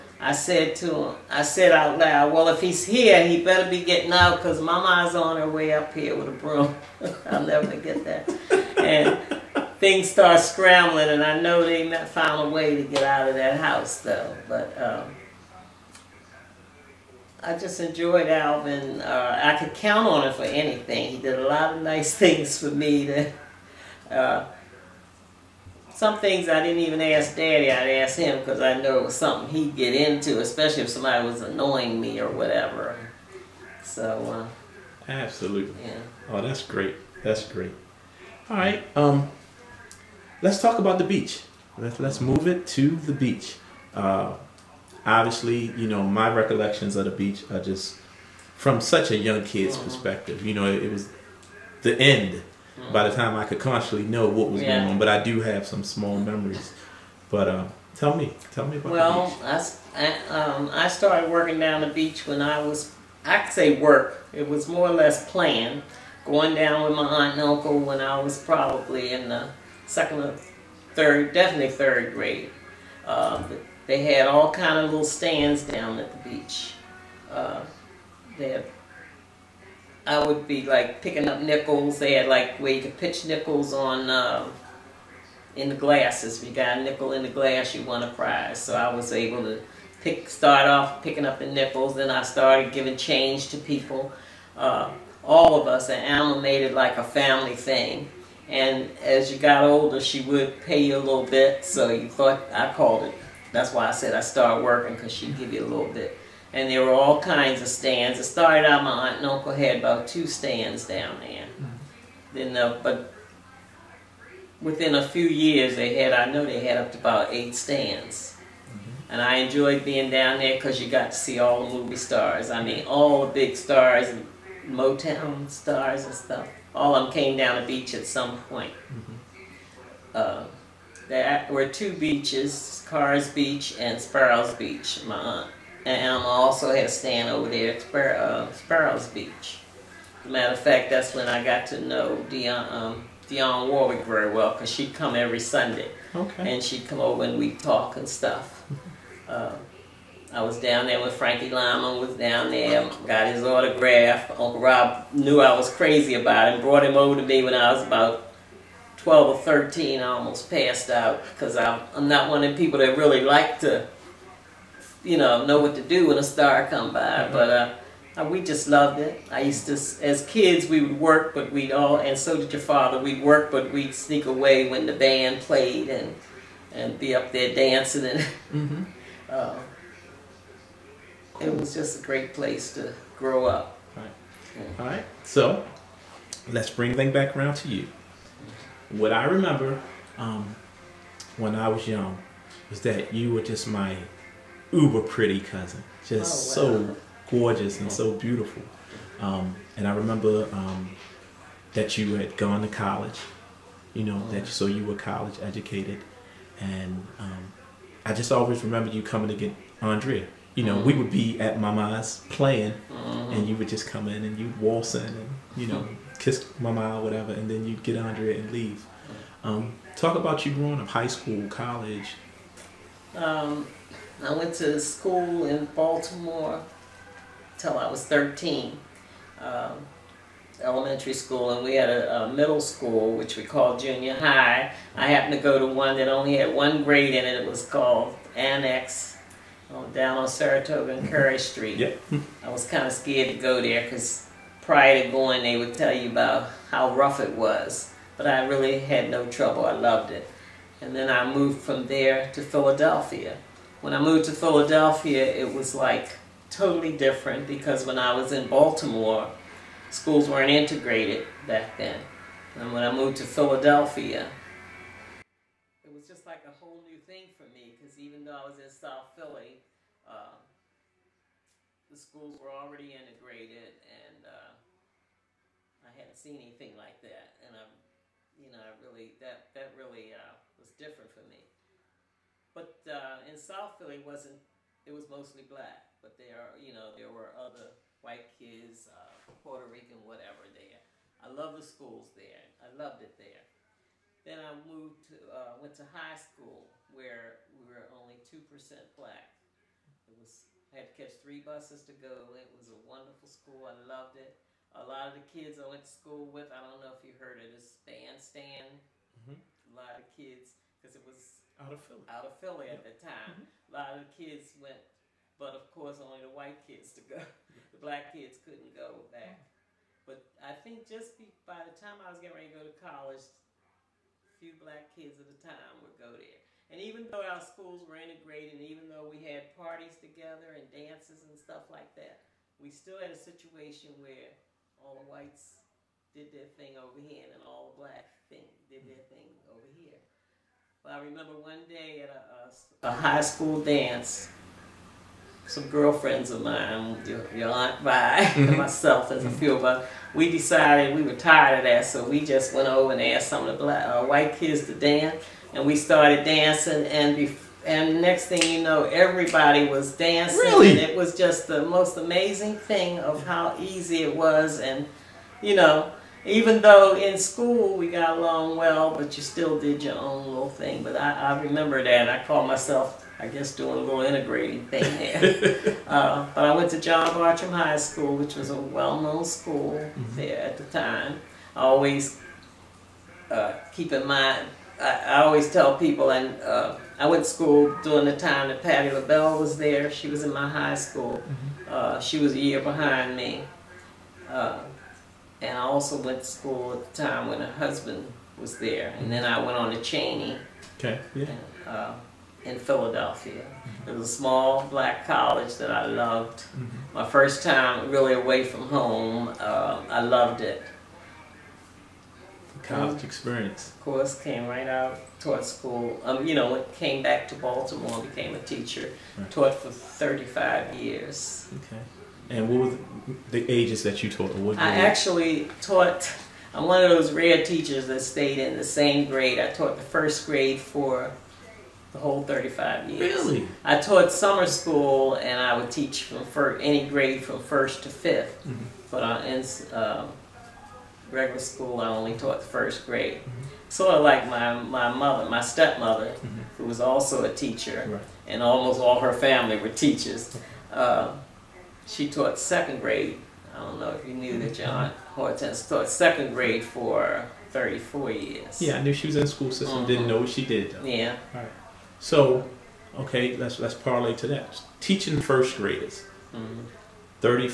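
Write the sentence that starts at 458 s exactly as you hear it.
Yeah, I knew she was in the school system, didn't know what she did.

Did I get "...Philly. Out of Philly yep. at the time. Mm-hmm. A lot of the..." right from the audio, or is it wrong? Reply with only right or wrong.
right.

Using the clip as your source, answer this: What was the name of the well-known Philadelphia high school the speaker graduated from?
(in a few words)
John Bartram High School.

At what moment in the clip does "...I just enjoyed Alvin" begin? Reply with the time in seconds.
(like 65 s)
17 s.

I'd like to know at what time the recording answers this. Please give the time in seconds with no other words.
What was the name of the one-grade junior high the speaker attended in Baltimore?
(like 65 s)
238 s.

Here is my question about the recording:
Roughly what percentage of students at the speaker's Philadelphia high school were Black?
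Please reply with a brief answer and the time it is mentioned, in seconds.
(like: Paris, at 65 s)
2 percent, at 298 s.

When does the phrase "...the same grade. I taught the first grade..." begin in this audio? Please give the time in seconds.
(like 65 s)
428 s.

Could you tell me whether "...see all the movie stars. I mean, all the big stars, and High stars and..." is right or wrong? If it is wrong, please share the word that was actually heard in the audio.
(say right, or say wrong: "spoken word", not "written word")
wrong: "Motown", not "High".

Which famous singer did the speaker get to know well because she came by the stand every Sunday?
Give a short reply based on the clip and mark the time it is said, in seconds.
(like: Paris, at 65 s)
Dionne Warwick, at 143 s.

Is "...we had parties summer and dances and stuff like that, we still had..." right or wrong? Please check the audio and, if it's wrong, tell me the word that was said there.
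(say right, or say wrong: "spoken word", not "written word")
wrong: "together", not "summer".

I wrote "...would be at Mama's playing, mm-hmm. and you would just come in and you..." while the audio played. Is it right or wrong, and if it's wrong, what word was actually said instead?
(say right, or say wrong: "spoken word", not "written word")
right.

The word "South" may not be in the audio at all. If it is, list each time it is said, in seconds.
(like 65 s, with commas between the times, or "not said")
268 s, 283 s.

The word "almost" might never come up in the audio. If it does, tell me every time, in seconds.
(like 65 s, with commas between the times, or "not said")
160 s, 448 s.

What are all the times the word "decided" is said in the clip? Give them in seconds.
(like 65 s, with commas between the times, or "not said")
350 s.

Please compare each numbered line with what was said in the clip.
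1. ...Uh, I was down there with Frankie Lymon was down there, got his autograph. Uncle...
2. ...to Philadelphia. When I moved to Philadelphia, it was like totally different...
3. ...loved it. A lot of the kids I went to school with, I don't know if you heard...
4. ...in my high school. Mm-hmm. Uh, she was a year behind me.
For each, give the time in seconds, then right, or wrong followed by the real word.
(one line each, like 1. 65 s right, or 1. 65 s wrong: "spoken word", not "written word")
1. 149 s right
2. 252 s right
3. 303 s right
4. 390 s right.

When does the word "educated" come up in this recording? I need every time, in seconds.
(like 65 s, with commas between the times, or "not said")
205 s.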